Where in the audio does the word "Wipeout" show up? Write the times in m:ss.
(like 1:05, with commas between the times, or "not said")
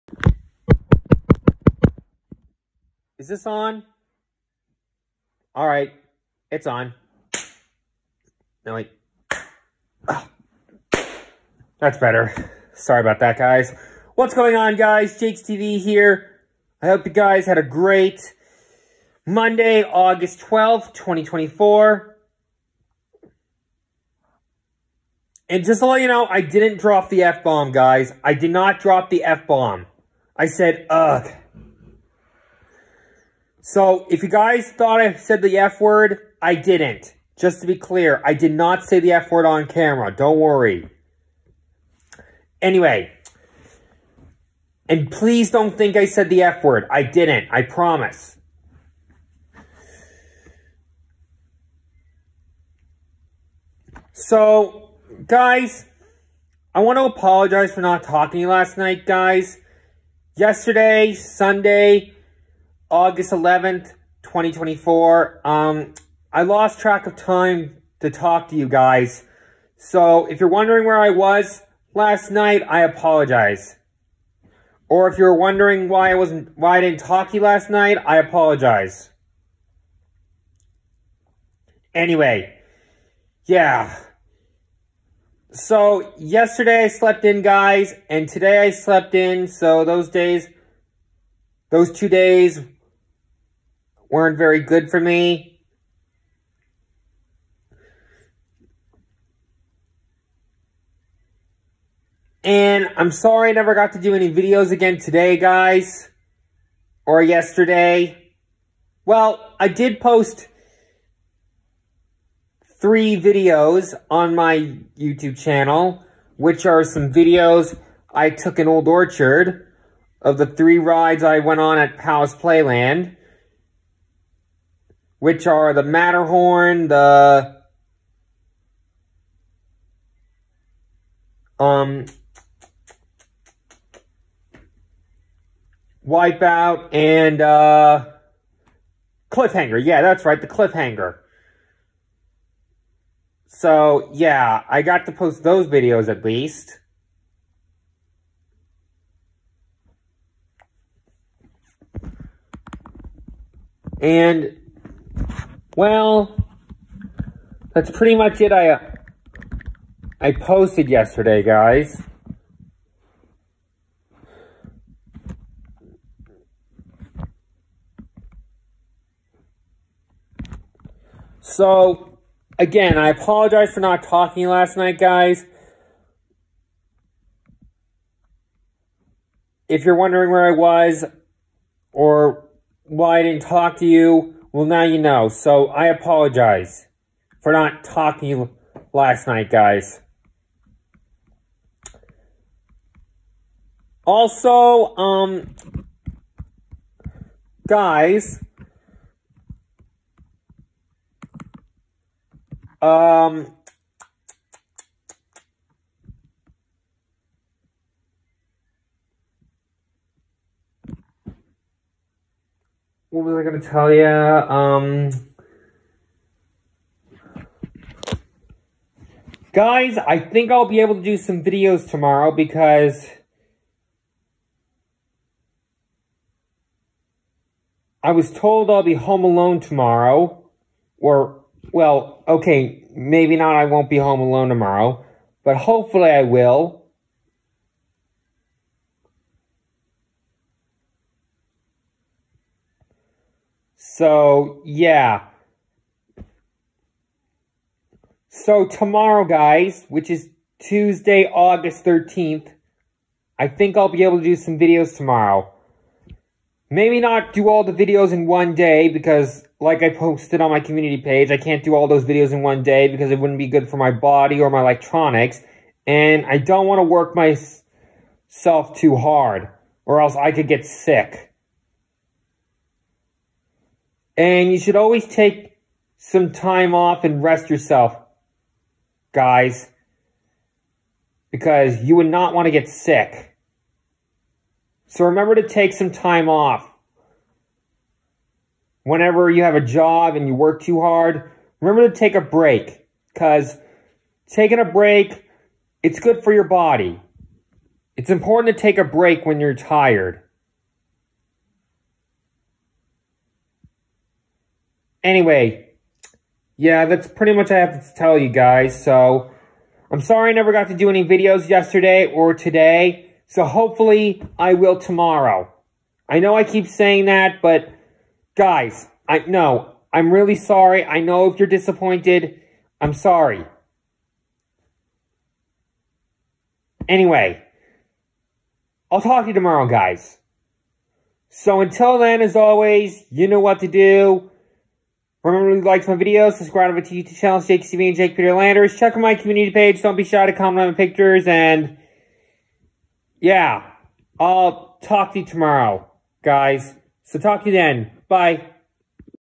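2:16.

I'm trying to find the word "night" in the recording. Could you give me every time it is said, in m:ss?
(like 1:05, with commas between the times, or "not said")
0:58, 1:12, 1:17, 2:54, 3:09.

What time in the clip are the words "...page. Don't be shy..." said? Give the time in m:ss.
5:39.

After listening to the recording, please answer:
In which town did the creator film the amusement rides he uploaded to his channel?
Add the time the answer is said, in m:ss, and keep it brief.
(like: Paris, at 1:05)
Old Orchard, at 1:58.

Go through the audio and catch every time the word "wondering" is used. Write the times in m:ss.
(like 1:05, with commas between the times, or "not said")
1:10, 1:15, 2:59.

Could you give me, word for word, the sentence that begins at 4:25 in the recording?
And I don't want to work myself too hard or else I could get sick.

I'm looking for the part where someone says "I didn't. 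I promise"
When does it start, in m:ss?
0:46.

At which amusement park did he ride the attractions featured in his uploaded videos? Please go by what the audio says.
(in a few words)
Palace Playland.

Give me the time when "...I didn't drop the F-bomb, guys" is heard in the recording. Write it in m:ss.
0:26.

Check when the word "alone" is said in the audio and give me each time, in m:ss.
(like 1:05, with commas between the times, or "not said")
3:49, 3:54.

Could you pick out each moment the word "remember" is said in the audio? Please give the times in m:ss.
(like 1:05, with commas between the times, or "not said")
4:45, 4:51, 5:35.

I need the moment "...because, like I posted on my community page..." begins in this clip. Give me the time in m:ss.
4:18.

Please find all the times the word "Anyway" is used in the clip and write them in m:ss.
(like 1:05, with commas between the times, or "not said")
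0:42, 1:21, 5:05, 5:26.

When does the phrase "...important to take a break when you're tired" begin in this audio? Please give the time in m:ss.
4:58.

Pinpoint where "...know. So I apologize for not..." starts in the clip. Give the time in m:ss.
3:04.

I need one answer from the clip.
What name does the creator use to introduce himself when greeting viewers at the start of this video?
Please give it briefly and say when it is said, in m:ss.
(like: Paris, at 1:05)
JaykesTV, at 0:15.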